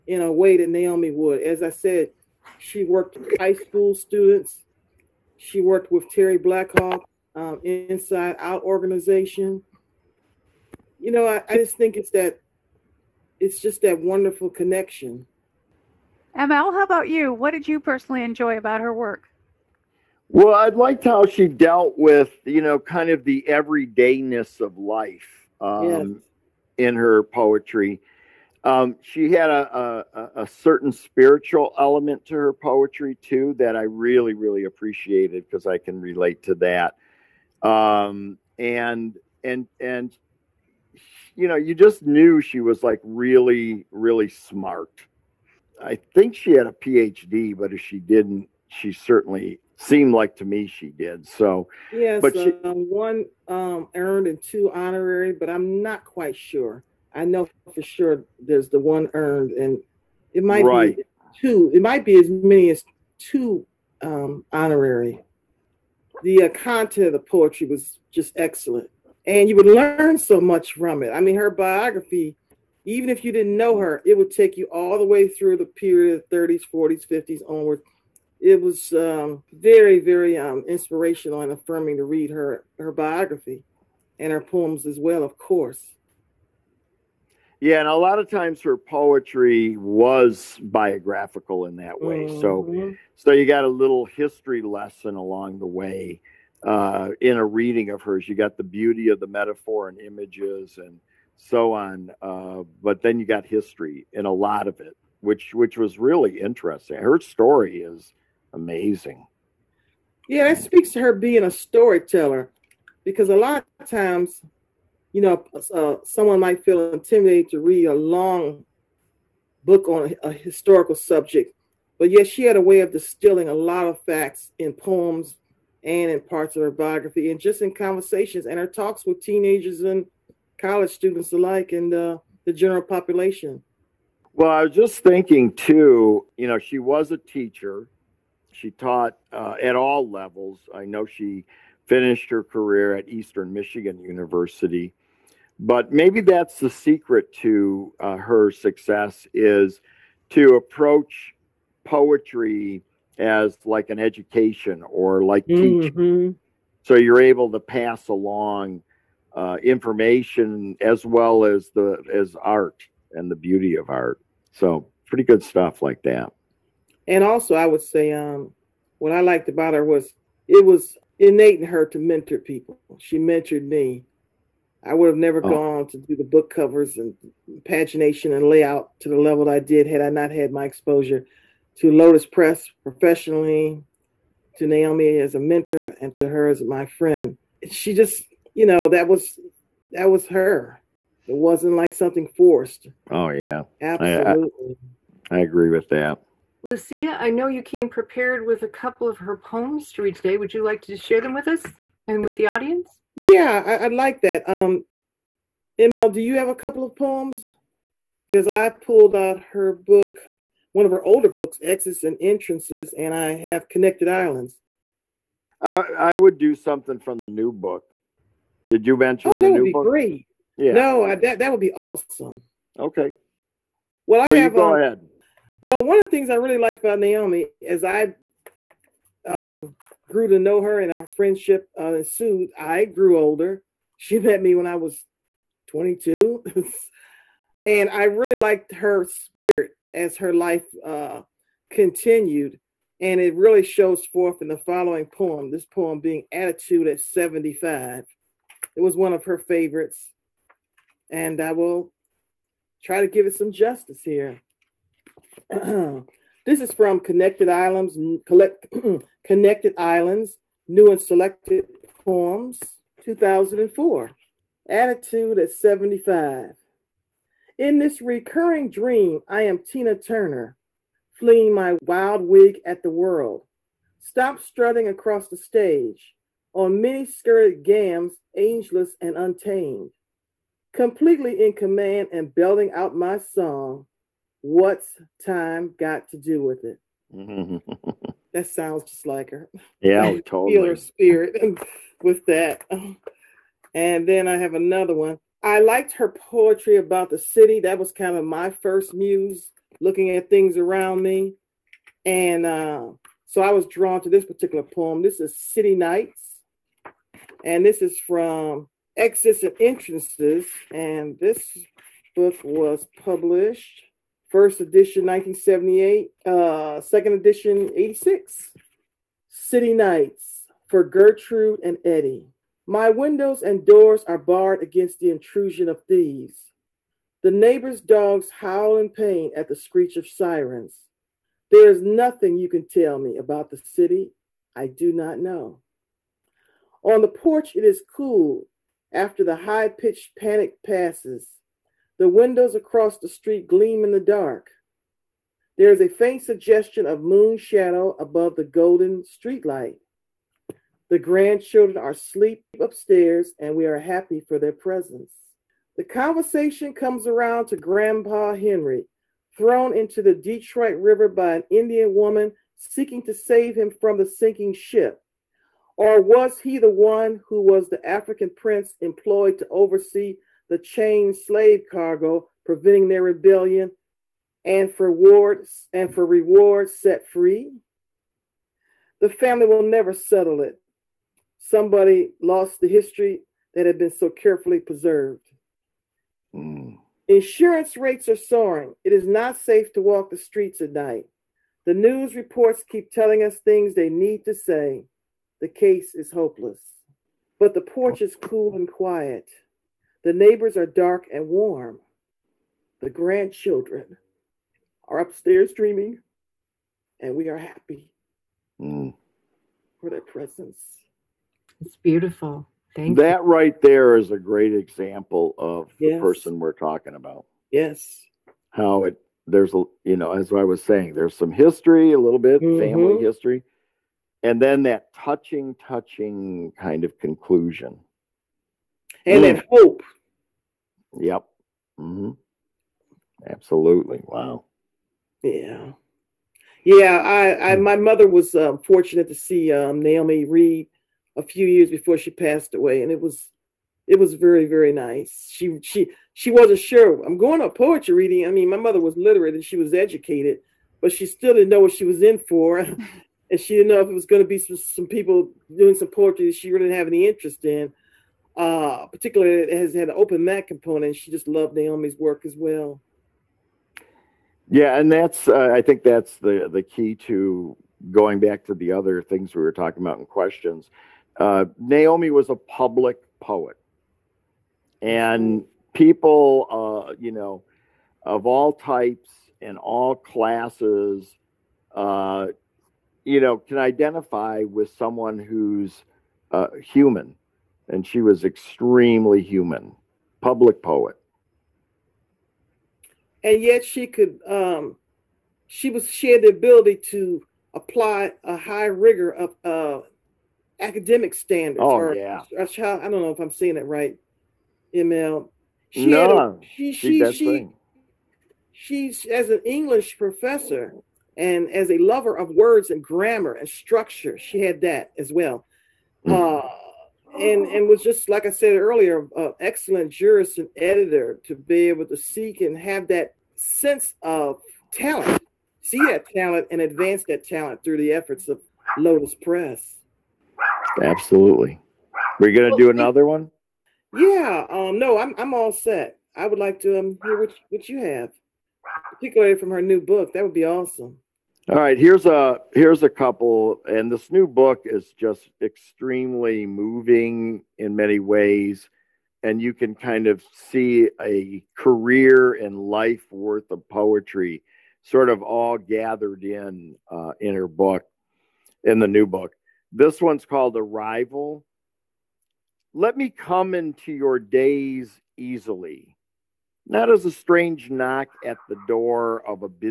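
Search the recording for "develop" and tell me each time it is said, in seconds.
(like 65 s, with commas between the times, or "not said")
not said.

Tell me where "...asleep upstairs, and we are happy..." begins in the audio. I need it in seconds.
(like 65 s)
351 s.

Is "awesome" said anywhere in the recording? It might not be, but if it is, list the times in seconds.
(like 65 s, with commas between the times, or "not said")
221 s, 540 s.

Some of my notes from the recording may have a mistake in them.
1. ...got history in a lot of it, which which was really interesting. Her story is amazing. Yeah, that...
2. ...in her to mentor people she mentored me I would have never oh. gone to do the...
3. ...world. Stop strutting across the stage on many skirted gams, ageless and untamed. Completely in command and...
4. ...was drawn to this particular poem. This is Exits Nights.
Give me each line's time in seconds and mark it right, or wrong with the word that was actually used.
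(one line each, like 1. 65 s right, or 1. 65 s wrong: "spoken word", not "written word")
1. 103 s right
2. 171 s right
3. 272 s right
4. 303 s wrong: "City", not "Exits".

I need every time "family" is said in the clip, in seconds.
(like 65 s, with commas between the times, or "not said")
379 s, 422 s.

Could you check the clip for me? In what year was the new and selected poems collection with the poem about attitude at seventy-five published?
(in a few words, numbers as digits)
2004.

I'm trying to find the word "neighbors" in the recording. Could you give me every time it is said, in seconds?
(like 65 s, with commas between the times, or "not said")
327 s, 400 s.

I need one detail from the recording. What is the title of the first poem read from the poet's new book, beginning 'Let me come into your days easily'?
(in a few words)
Arrival.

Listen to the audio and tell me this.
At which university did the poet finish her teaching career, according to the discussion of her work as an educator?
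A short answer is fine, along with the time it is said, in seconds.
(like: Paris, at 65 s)
Eastern Michigan University, at 143 s.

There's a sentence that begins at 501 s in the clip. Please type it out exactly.
Oh or, yeah, child, I don't know if I'm saying it right, ML.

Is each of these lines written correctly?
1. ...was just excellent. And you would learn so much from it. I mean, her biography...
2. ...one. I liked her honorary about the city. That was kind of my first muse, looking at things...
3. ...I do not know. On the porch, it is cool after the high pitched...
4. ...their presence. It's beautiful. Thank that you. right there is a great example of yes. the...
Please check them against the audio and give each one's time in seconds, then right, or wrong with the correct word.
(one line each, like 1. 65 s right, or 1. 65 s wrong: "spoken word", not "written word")
1. 67 s right
2. 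294 s wrong: "poetry", not "honorary"
3. 334 s right
4. 409 s right.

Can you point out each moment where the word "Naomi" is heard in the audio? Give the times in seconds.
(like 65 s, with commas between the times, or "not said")
0 s, 184 s, 226 s, 439 s, 461 s, 471 s.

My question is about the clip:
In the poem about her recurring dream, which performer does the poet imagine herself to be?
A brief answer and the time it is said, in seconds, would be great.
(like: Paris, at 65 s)
Tina Turner, at 269 s.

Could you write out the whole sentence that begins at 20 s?
Well, I liked how she dealt with, you know, kind of the everydayness of life um, yes.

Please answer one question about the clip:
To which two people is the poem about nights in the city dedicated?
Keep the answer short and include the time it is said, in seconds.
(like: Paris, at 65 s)
Gertrude and Eddie, at 320 s.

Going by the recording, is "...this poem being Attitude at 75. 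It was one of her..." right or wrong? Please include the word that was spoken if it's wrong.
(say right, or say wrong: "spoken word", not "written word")
right.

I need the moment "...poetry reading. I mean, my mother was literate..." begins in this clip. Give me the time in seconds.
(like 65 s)
447 s.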